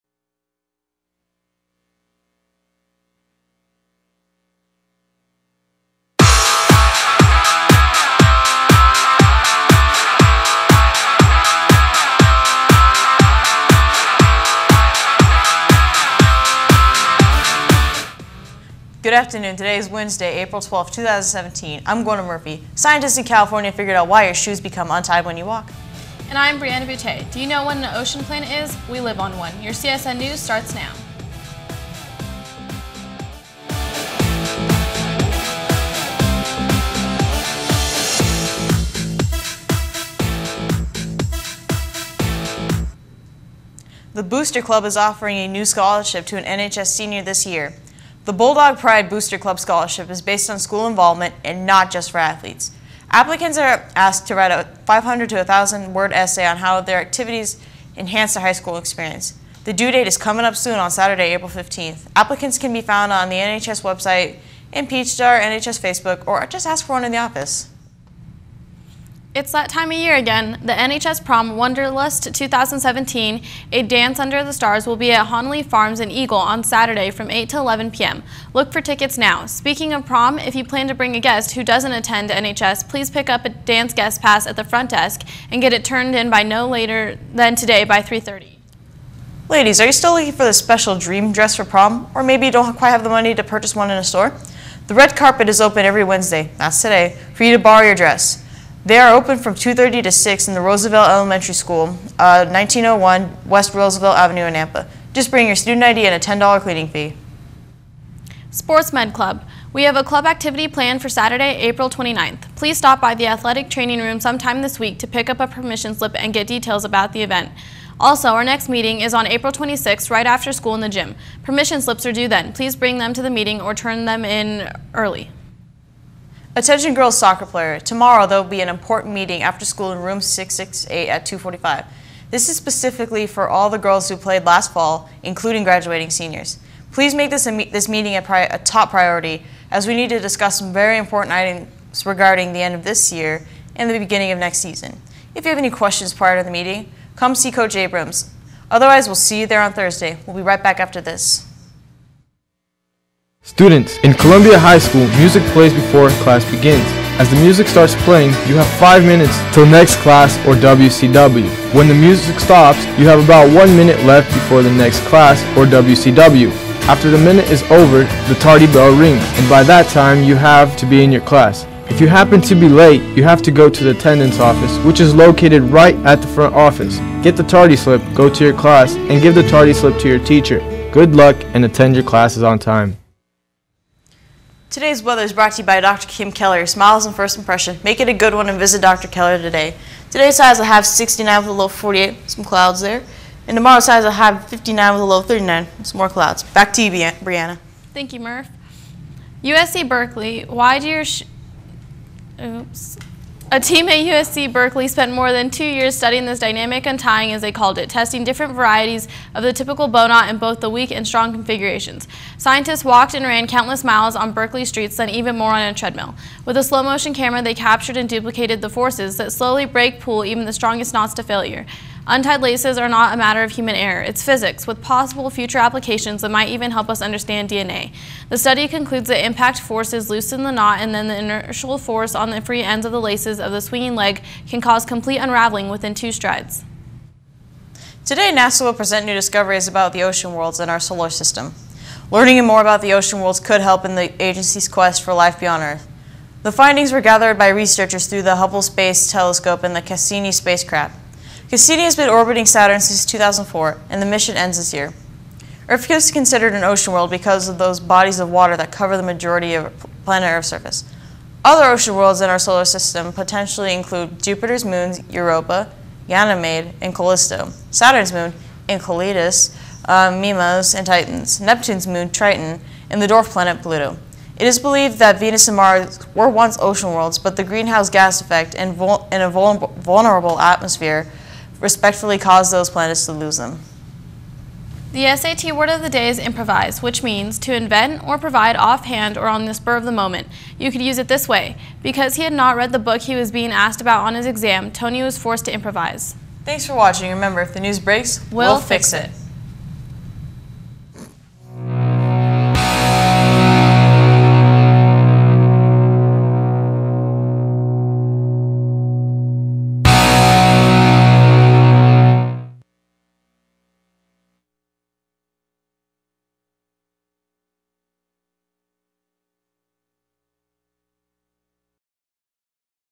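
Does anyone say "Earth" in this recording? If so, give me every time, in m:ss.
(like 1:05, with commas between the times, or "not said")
4:05, 4:15, 4:20.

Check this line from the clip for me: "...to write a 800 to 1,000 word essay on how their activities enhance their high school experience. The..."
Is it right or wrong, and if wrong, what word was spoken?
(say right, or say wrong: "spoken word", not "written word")
wrong: "500", not "800".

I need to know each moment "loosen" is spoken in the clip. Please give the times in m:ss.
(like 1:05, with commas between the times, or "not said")
3:50.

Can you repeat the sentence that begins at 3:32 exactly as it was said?
Scientists walked and ran countless miles on Berkeley streets, then even more on a treadmill.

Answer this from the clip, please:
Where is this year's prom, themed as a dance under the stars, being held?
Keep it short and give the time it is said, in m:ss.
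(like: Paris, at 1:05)
Honley Farms, at 1:15.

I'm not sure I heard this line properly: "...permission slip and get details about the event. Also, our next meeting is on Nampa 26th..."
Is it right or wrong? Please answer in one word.
wrong.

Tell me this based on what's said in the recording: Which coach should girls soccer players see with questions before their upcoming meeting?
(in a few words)
Coach Abrams.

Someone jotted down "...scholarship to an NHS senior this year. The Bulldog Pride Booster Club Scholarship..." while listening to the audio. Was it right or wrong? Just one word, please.
right.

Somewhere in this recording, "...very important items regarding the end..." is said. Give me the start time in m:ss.
2:20.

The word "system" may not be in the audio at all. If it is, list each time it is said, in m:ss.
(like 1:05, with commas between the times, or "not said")
4:01, 4:22.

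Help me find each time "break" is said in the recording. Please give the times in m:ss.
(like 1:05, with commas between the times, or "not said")
3:39, 4:57.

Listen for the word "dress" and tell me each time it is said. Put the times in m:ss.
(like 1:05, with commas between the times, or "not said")
1:31, 1:37.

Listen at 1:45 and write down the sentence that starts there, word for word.
Just bring your student ID and a $10 cleaning fee.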